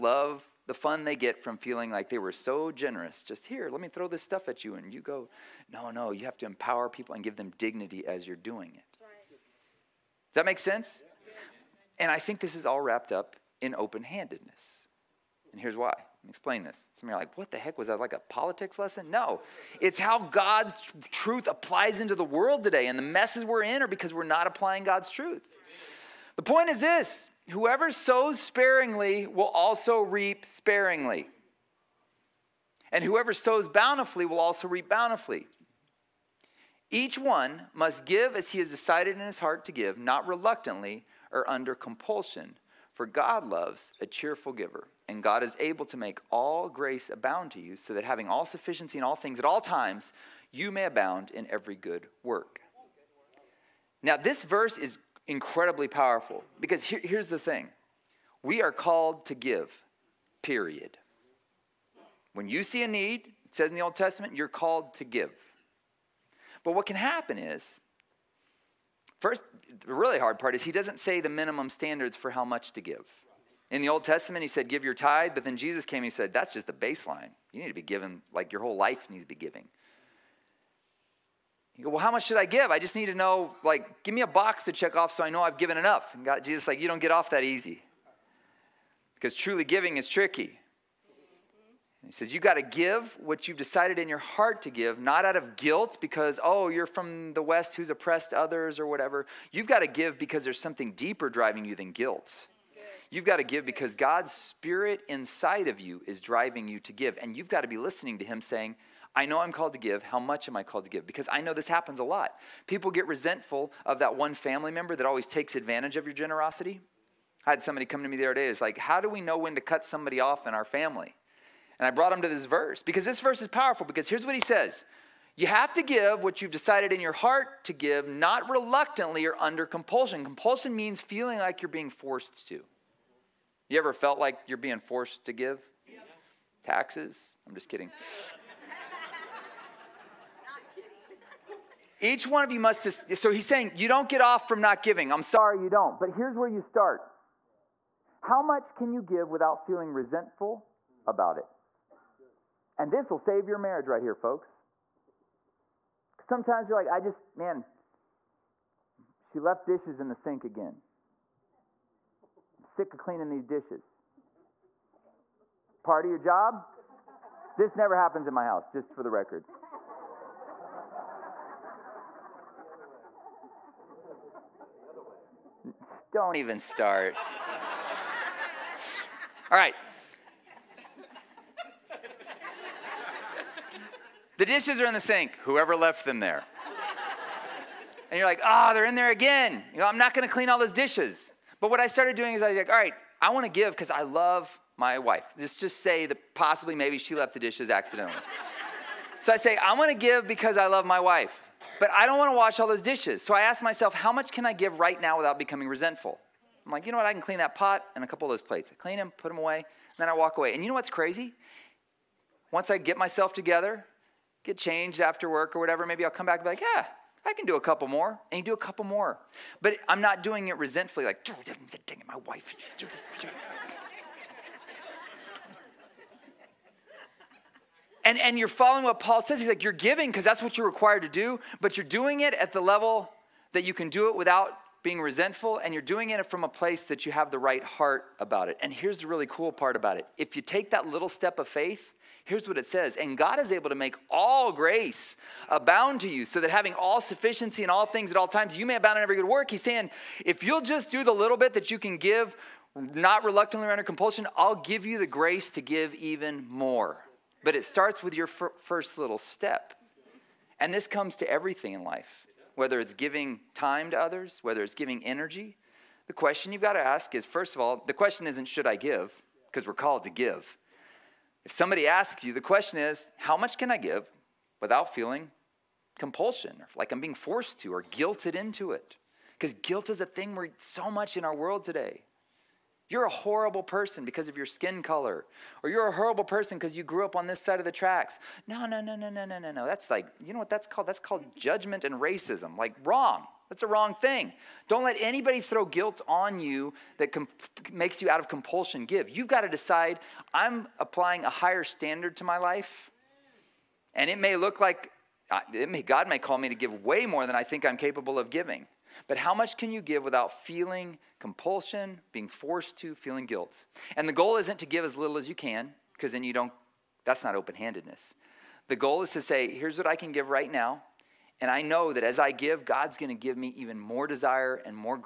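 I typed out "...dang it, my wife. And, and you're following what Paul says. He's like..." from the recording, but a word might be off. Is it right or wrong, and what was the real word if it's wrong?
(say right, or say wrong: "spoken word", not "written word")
right.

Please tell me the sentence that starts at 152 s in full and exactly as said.
And this will save your marriage right here, folks.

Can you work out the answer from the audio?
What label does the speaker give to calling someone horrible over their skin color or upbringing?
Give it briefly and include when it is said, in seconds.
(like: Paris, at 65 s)
judgment and racism, at 291 s.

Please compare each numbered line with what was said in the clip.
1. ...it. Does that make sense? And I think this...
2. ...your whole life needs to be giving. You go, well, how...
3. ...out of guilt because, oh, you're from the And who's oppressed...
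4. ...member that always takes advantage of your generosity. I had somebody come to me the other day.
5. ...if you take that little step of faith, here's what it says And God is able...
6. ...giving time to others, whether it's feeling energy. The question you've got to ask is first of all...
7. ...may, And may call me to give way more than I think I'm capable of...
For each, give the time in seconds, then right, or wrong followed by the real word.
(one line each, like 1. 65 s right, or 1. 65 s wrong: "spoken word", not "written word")
1. 8 s right
2. 78 s right
3. 95 s wrong: "West", not "And"
4. 114 s right
5. 240 s right
6. 262 s wrong: "giving", not "feeling"
7. 305 s wrong: "God", not "And".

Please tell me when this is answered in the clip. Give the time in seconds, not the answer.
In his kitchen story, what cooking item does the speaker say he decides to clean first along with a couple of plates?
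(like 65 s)
207 s.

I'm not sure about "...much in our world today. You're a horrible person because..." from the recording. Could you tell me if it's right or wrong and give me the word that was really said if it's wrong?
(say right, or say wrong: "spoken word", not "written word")
right.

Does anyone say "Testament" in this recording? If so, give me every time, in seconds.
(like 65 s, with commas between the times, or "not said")
63 s, 74 s.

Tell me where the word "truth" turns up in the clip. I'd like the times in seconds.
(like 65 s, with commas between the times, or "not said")
21 s, 25 s.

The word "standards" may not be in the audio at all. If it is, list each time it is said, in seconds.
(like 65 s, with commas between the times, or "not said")
71 s, 301 s.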